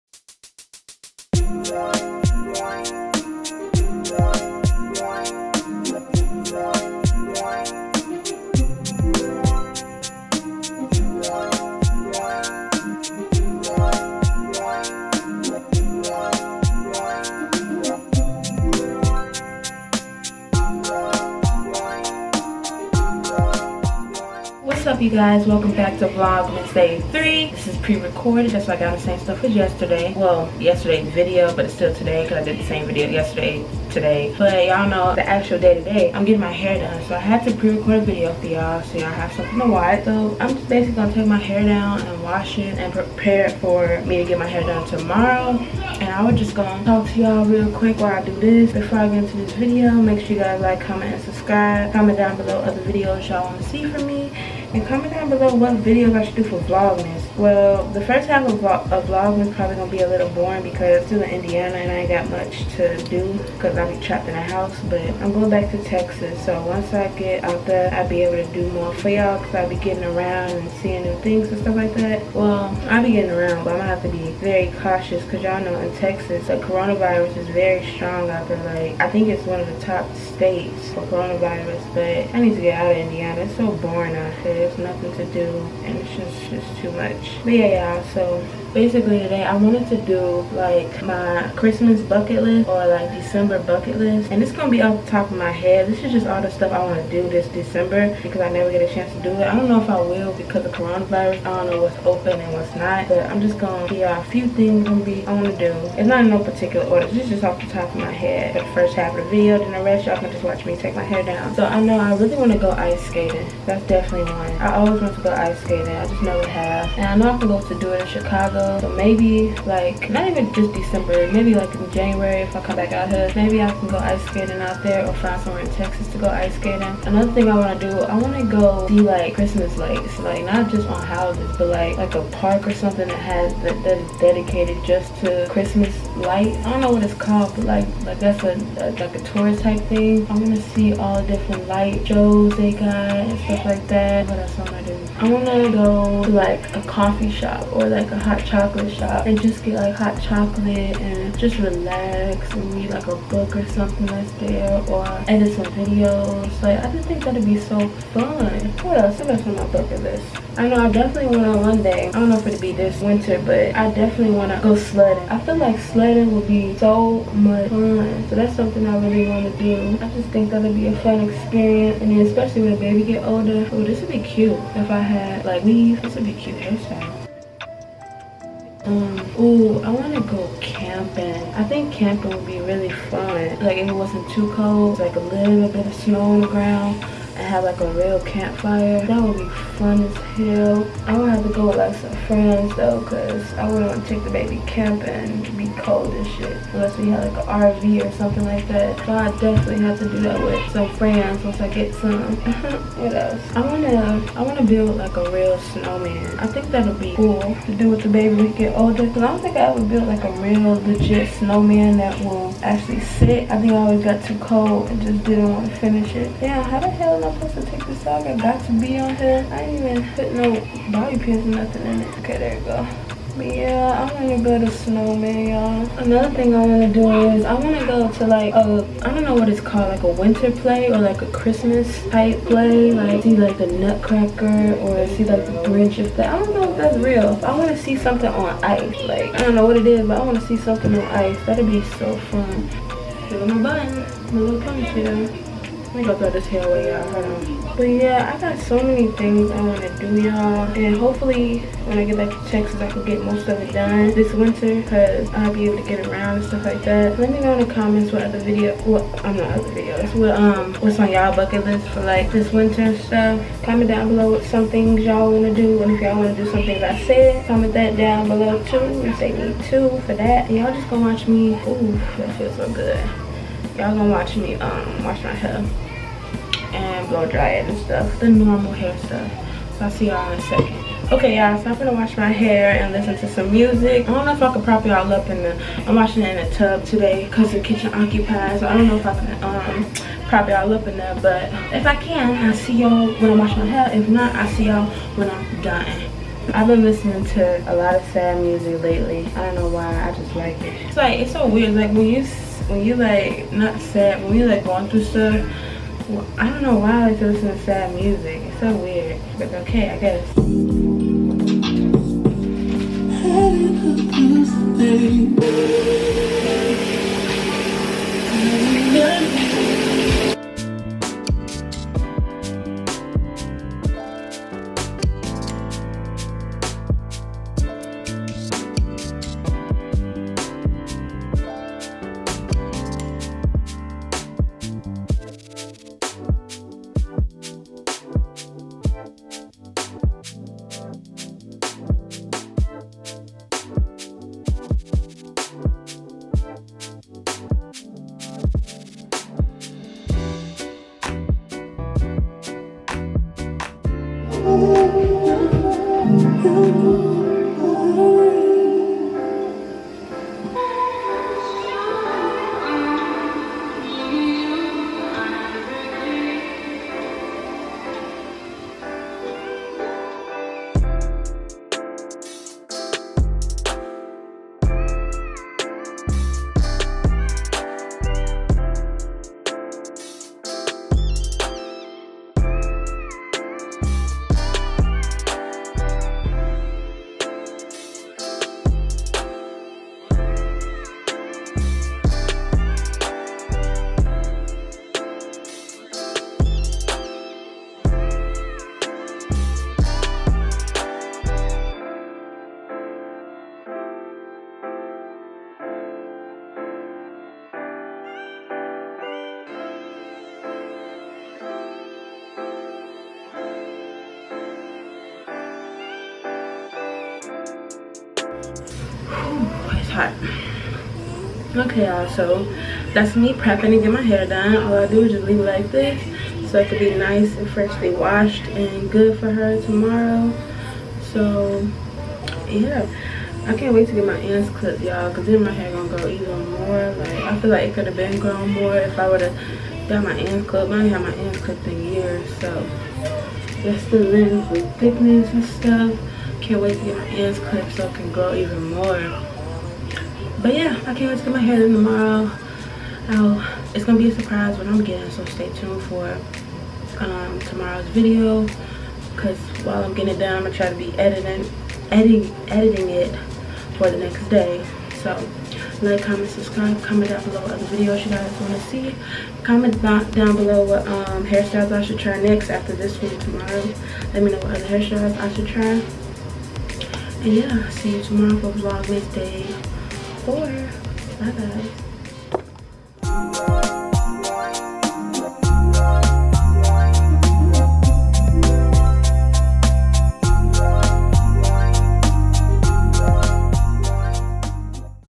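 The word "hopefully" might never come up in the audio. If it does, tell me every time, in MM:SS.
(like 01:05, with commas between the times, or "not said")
04:10.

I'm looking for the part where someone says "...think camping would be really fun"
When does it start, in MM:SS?
03:01.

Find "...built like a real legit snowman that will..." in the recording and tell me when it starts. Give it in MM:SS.
03:29.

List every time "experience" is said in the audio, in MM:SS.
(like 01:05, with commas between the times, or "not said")
02:51.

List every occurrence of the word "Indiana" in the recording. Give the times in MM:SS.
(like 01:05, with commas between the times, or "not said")
01:01, 01:22.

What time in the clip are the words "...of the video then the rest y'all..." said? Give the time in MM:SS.
01:49.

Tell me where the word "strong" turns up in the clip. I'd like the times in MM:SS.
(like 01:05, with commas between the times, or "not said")
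01:17.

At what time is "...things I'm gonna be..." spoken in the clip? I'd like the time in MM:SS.
01:44.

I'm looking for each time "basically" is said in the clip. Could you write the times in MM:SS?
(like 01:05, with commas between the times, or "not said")
00:40, 01:28.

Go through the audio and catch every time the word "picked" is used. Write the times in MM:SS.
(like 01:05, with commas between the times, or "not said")
not said.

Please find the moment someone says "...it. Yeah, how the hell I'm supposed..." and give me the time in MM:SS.
03:36.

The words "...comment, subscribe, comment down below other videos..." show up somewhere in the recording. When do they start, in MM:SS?
07:46.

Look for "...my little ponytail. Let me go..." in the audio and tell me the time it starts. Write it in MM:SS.
04:03.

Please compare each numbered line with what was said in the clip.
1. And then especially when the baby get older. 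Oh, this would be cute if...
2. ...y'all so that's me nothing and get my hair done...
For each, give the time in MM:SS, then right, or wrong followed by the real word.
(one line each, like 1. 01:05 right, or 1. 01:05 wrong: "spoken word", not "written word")
1. 02:52 right
2. 07:01 wrong: "prepping", not "nothing".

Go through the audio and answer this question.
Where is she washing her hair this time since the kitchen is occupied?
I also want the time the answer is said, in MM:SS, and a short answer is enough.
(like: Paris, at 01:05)
In a tub, at 04:46.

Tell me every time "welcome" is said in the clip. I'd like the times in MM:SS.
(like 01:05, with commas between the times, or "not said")
00:25.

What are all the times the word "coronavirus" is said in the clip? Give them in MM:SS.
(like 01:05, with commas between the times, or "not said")
01:16, 01:21, 01:40.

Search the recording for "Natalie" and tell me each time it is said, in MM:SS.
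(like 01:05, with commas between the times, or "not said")
not said.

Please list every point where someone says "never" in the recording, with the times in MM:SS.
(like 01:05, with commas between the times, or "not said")
01:38, 01:56.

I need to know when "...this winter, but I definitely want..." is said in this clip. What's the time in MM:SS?
02:42.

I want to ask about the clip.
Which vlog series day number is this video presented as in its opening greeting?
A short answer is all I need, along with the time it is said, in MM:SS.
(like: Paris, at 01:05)
3, at 00:26.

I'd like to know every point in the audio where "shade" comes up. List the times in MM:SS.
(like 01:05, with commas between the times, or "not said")
not said.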